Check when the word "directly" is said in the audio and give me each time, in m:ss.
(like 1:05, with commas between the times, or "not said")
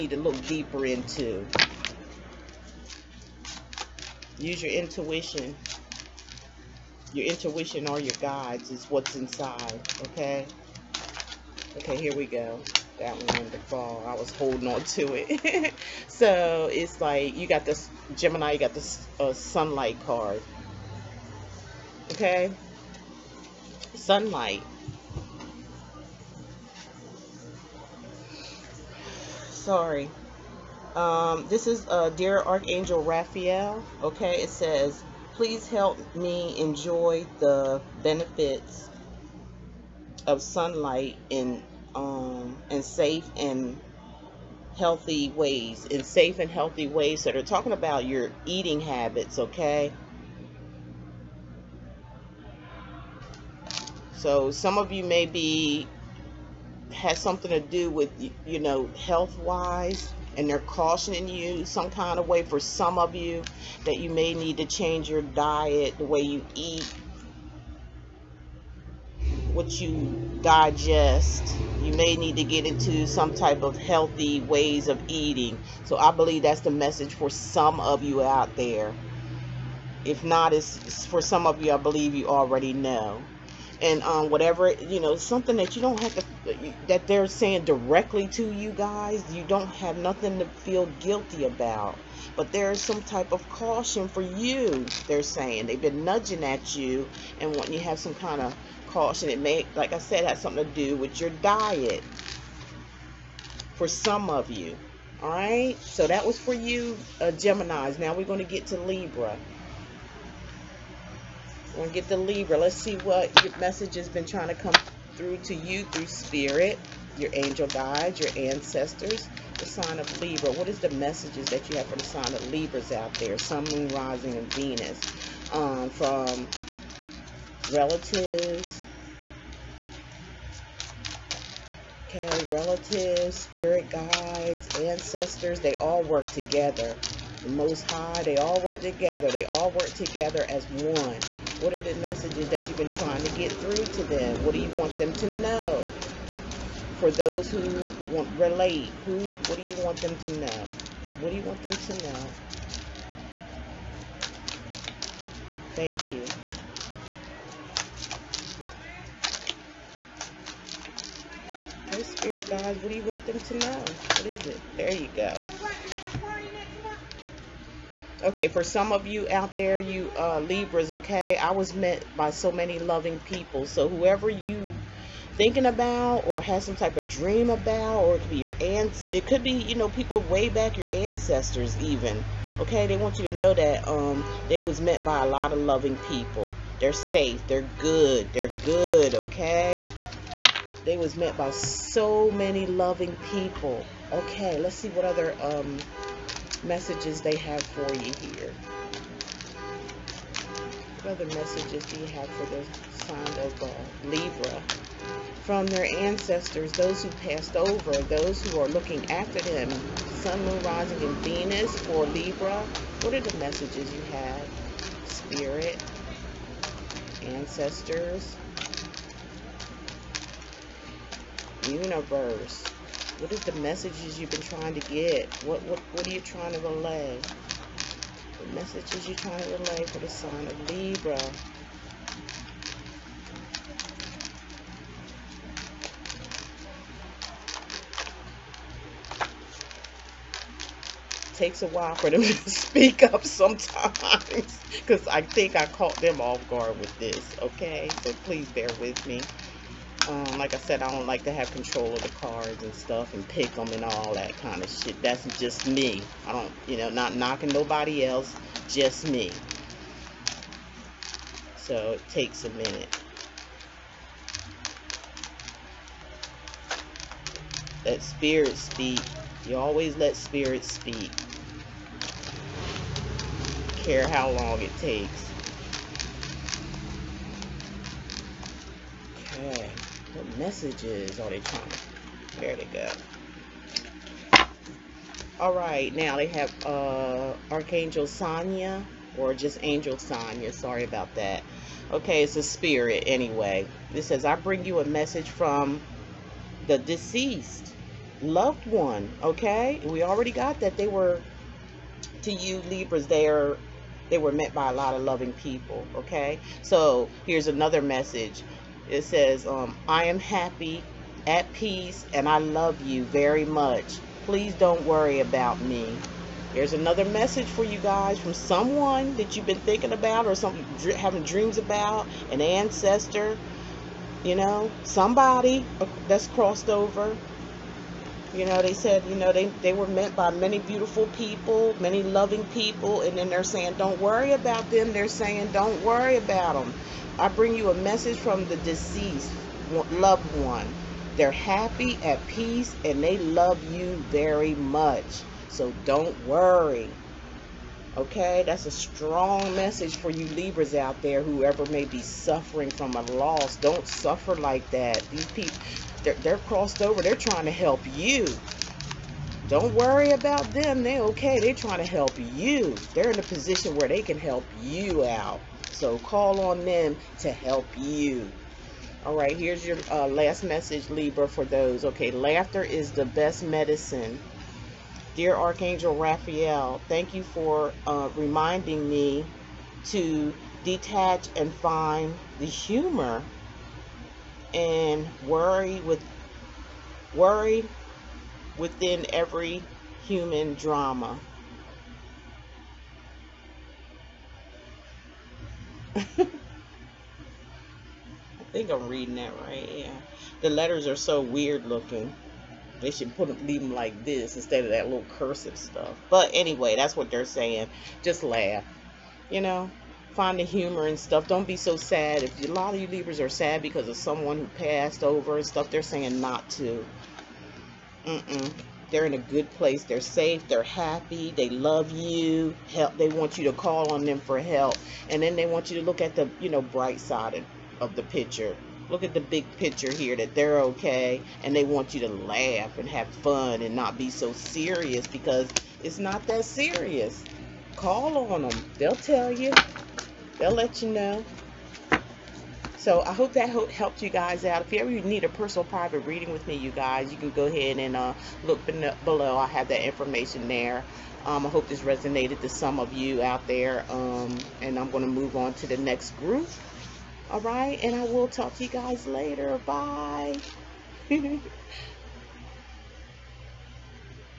1:27.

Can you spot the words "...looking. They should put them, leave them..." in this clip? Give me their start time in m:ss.
6:41.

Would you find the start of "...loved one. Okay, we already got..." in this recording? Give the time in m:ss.
4:58.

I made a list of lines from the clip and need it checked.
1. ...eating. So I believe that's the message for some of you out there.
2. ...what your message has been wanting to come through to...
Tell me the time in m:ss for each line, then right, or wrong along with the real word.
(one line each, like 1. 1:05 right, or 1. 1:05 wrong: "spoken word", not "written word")
1. 1:15 right
2. 1:52 wrong: "trying", not "wanting".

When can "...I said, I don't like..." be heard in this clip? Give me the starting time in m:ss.
4:10.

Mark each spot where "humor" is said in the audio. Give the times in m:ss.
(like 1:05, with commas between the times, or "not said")
6:22, 6:50.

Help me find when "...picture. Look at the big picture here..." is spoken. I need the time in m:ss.
7:08.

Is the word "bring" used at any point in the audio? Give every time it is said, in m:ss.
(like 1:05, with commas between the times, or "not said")
4:54, 5:37.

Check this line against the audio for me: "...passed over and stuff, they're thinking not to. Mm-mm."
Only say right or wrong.
wrong.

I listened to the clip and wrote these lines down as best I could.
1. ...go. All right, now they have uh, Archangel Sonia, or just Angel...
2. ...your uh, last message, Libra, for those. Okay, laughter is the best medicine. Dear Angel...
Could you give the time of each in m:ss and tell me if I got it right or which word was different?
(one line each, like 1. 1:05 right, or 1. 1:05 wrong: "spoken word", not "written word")
1. 4:42 right
2. 6:09 wrong: "Archangel", not "Angel".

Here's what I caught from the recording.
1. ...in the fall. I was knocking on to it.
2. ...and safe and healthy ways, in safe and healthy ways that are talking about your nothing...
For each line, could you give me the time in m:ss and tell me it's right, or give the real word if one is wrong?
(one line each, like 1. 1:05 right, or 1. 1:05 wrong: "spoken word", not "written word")
1. 0:13 wrong: "holding", not "knocking"
2. 0:42 wrong: "eating", not "nothing".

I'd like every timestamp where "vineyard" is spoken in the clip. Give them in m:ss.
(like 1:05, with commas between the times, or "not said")
not said.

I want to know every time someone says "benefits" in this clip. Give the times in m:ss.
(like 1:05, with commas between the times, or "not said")
0:38.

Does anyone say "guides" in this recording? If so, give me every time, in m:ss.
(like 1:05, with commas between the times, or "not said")
0:08, 1:57, 2:13.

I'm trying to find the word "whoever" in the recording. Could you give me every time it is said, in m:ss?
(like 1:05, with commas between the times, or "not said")
2:53, 5:51.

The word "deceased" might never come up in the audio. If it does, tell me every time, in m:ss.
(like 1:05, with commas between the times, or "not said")
4:56, 5:38.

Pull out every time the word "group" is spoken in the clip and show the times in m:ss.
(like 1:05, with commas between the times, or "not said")
7:36.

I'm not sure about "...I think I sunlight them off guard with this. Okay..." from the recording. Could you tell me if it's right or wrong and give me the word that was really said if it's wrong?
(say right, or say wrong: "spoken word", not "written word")
wrong: "caught", not "sunlight".